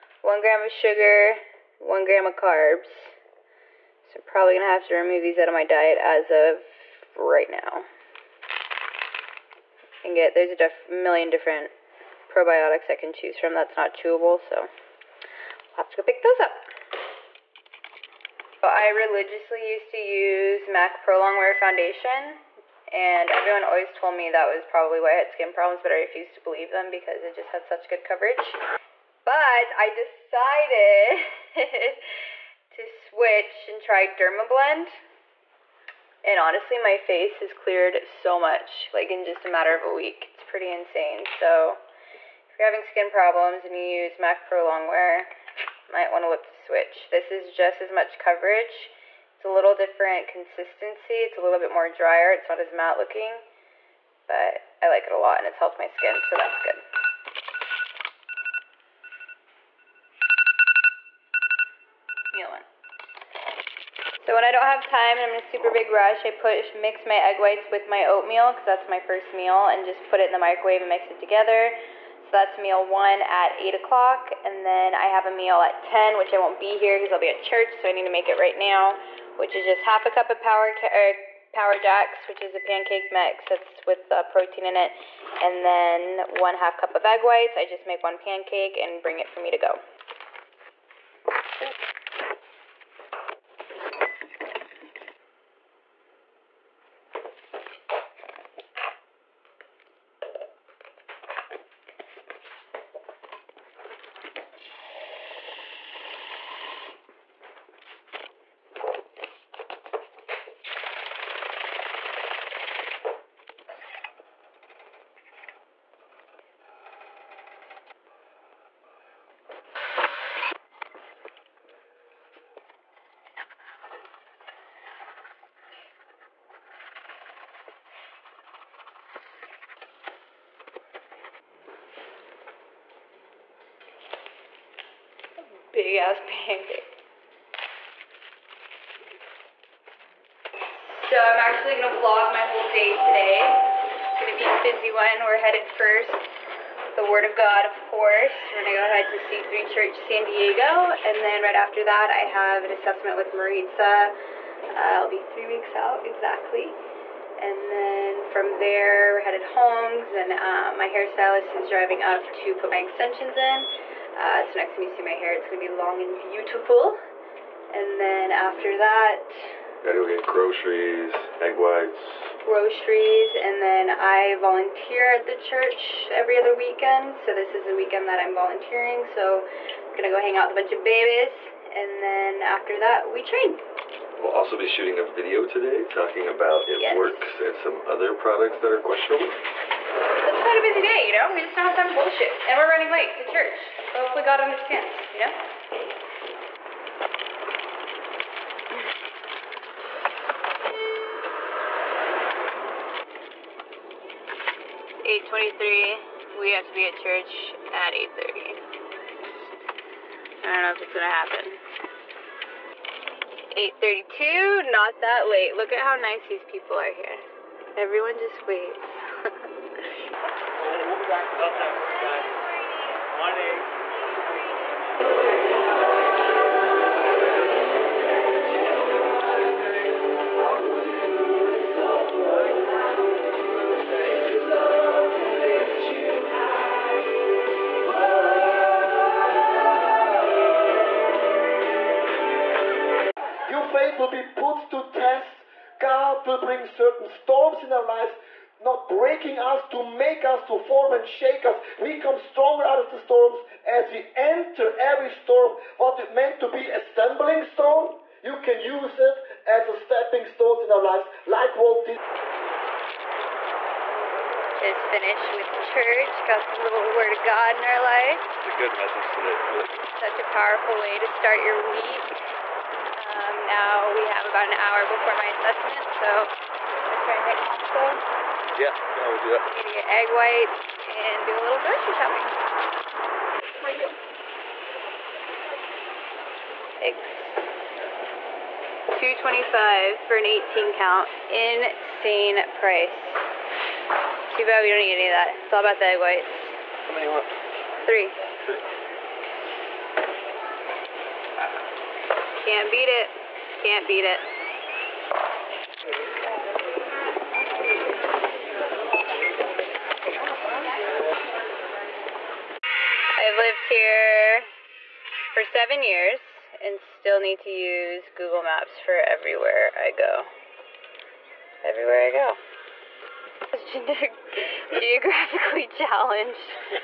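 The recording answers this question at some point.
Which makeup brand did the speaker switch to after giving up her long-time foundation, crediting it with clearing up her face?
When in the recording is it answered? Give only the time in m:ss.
0:34.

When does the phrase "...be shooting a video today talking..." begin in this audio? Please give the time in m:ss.
3:04.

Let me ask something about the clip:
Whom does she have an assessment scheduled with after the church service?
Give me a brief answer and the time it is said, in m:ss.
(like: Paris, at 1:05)
Maritza, at 2:33.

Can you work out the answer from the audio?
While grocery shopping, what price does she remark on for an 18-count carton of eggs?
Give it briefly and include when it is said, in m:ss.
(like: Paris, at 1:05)
2.25, at 4:48.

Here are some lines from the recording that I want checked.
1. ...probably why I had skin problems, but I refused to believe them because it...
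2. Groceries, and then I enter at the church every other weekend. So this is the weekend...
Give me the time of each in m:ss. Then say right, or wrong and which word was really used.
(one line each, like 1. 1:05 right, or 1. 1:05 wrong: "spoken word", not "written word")
1. 0:24 right
2. 2:52 wrong: "volunteer", not "enter".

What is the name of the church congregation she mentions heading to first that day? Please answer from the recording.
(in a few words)
C3 Church San Diego.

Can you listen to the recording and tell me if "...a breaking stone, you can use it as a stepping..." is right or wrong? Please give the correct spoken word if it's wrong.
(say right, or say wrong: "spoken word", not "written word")
wrong: "stumbling", not "breaking".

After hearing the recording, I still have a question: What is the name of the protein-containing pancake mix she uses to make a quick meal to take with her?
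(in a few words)
Power Jacks.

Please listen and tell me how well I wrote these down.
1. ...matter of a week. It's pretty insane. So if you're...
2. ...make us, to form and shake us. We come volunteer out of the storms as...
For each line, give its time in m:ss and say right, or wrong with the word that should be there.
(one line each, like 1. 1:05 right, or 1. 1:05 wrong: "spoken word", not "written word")
1. 0:39 right
2. 4:09 wrong: "stronger", not "volunteer".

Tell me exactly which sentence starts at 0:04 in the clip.
So I'm probably gonna have to remove these out of my diet as of right now.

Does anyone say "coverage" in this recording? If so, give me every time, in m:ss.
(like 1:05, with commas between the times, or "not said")
0:28, 0:48.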